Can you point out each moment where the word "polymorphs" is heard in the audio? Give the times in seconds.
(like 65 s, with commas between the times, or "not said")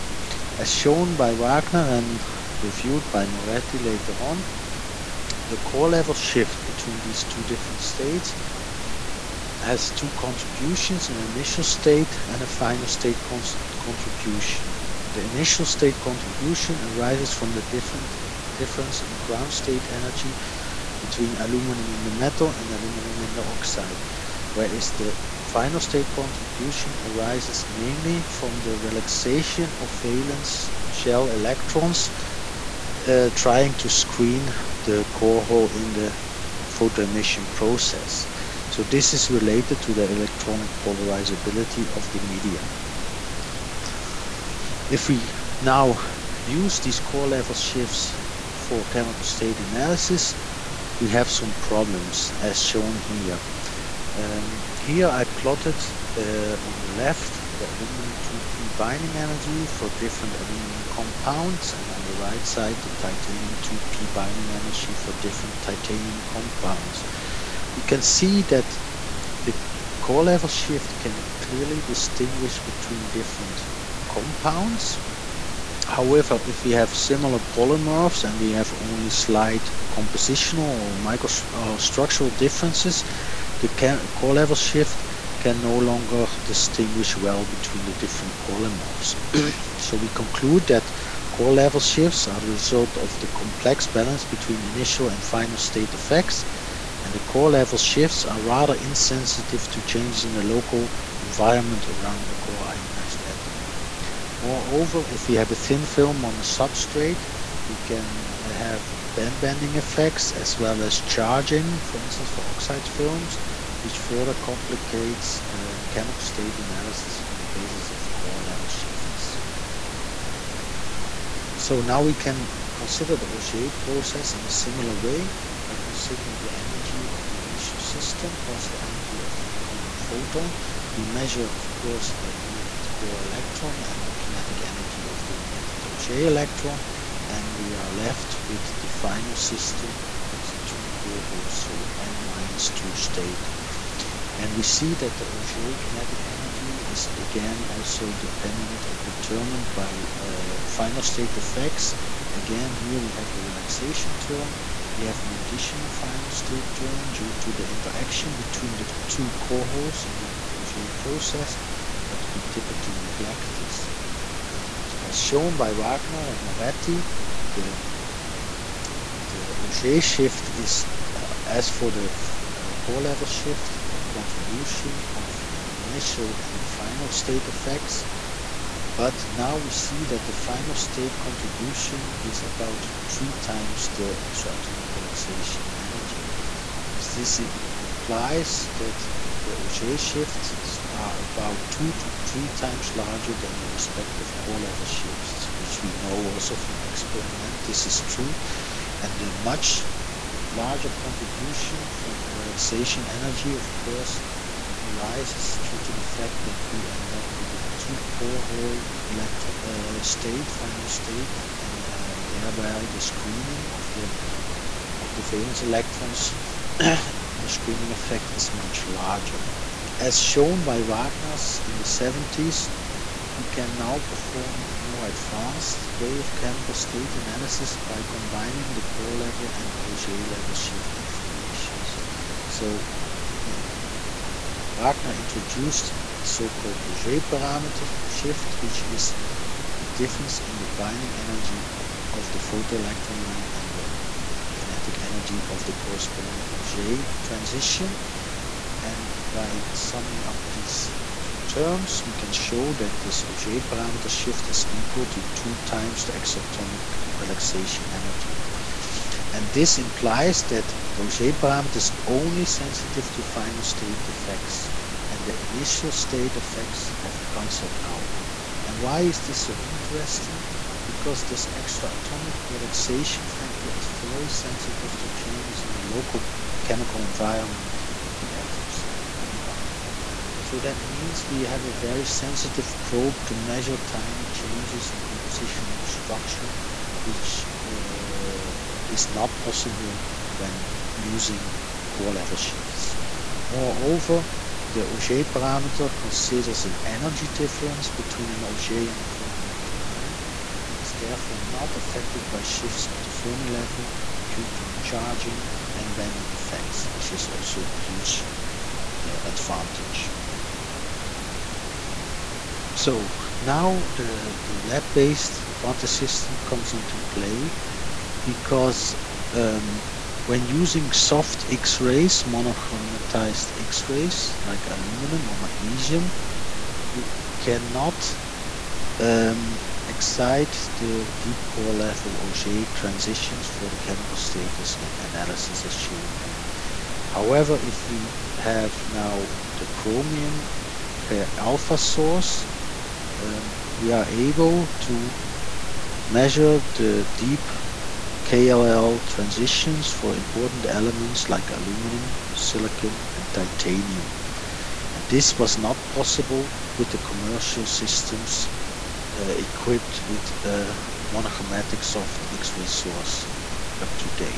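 77 s, 88 s.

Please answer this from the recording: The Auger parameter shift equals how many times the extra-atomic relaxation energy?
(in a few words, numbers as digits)
2.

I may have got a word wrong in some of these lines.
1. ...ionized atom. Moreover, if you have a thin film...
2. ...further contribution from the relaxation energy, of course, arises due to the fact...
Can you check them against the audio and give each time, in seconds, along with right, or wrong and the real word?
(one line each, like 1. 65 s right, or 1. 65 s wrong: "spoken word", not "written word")
1. 102 s right
2. 200 s wrong: "larger", not "further".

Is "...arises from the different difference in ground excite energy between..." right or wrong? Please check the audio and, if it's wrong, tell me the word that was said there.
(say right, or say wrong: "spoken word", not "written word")
wrong: "state", not "excite".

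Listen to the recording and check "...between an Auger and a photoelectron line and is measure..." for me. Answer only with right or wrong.
wrong.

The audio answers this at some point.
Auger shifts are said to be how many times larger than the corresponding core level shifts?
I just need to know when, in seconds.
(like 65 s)
191 s.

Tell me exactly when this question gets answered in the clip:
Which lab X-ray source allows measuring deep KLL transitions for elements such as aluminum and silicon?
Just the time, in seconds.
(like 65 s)
339 s.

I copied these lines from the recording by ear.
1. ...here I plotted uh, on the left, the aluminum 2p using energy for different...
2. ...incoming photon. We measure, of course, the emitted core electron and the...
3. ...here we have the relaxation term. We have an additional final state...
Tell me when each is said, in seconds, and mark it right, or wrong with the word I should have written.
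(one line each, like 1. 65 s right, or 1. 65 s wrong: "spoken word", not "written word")
1. 54 s wrong: "binding", not "using"
2. 129 s right
3. 152 s right.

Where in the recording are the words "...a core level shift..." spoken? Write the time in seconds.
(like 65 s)
172 s.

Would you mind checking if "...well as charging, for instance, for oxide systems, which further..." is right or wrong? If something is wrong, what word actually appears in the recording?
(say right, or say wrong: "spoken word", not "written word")
wrong: "films", not "systems".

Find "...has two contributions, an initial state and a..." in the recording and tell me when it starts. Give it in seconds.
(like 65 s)
9 s.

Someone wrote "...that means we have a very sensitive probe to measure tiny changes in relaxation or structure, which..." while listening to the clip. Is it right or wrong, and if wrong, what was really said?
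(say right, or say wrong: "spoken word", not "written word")
wrong: "composition", not "relaxation".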